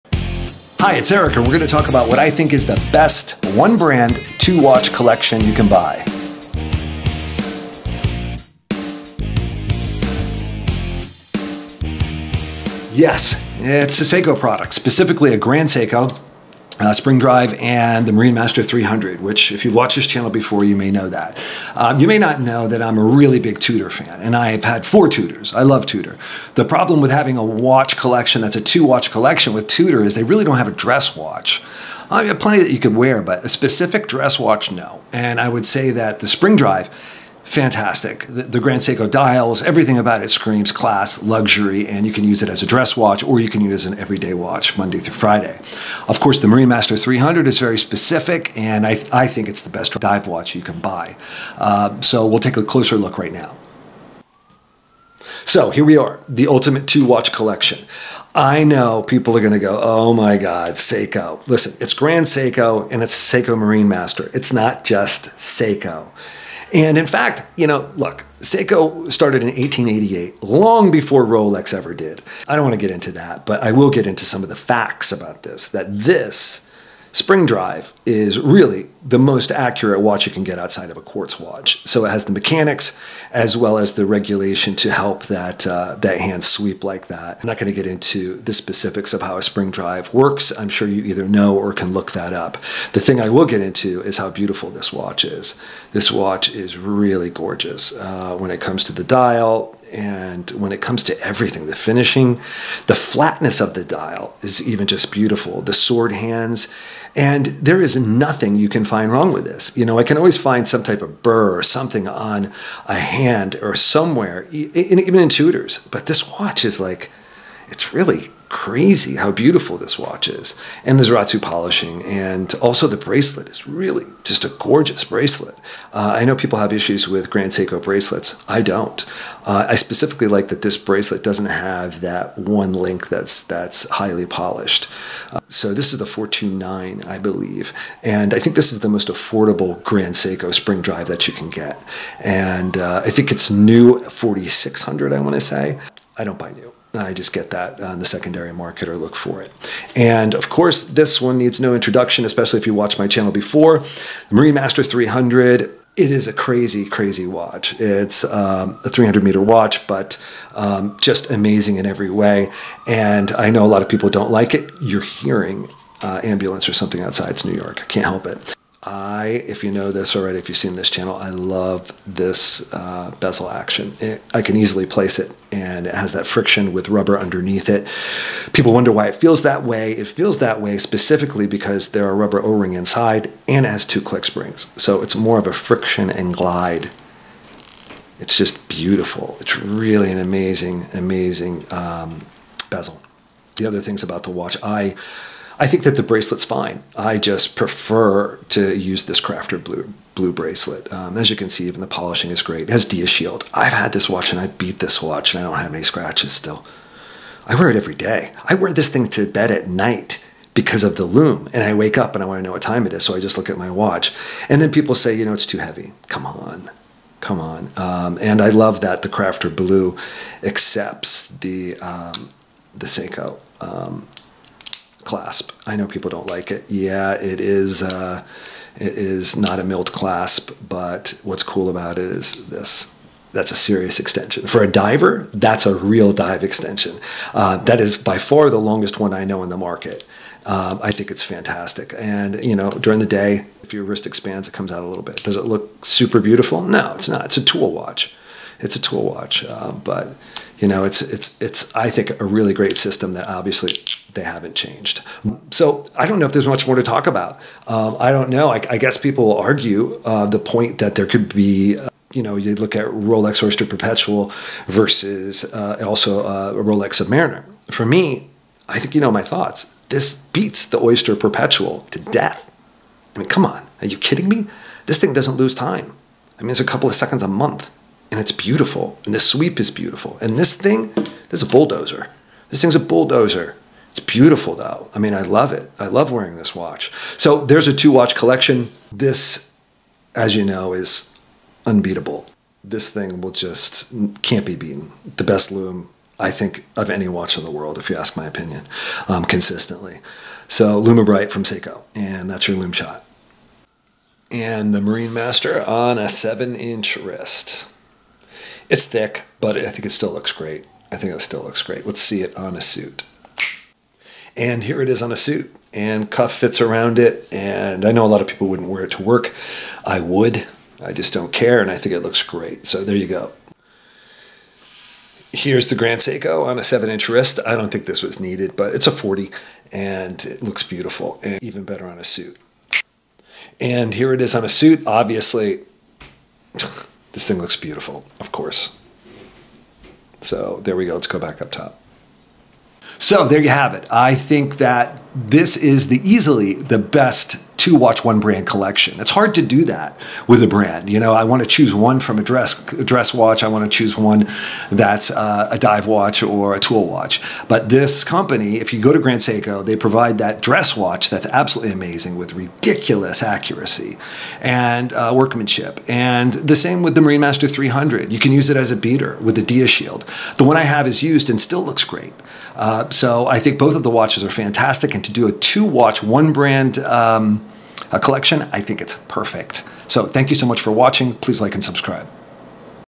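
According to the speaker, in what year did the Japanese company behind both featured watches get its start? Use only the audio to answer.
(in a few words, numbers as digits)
1888.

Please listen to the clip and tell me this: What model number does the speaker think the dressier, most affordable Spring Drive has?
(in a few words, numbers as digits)
429.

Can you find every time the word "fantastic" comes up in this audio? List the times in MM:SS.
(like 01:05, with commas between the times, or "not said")
00:37, 04:01, 06:14.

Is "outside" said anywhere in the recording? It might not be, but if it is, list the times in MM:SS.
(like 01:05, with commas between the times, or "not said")
01:20, 02:47.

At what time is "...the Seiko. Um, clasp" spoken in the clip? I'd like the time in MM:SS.
03:42.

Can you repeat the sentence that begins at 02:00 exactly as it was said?
And the Zaratsu polishing, and also the bracelet is really just a gorgeous bracelet.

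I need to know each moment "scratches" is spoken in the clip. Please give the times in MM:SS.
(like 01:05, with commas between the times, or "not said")
03:25.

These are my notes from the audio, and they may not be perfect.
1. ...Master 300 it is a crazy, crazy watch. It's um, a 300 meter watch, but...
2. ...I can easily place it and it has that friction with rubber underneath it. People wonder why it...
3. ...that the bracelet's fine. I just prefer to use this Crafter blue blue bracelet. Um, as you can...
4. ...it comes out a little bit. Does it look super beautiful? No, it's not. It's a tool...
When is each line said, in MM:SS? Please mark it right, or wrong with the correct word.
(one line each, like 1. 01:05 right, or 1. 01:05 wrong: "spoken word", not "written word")
1. 02:34 right
2. 02:54 right
3. 03:15 right
4. 04:04 right.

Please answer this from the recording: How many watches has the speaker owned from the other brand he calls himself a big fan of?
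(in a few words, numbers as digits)
4.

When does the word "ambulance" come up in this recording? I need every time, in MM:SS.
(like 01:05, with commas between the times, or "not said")
02:46.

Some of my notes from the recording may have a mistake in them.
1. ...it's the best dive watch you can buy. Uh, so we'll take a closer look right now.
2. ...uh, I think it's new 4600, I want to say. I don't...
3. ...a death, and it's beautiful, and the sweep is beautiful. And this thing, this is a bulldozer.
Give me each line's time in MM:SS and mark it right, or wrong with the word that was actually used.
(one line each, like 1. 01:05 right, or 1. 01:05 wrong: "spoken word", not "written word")
1. 00:49 right
2. 02:22 right
3. 04:37 wrong: "month", not "death".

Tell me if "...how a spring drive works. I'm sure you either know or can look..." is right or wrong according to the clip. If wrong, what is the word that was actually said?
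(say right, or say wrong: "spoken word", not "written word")
right.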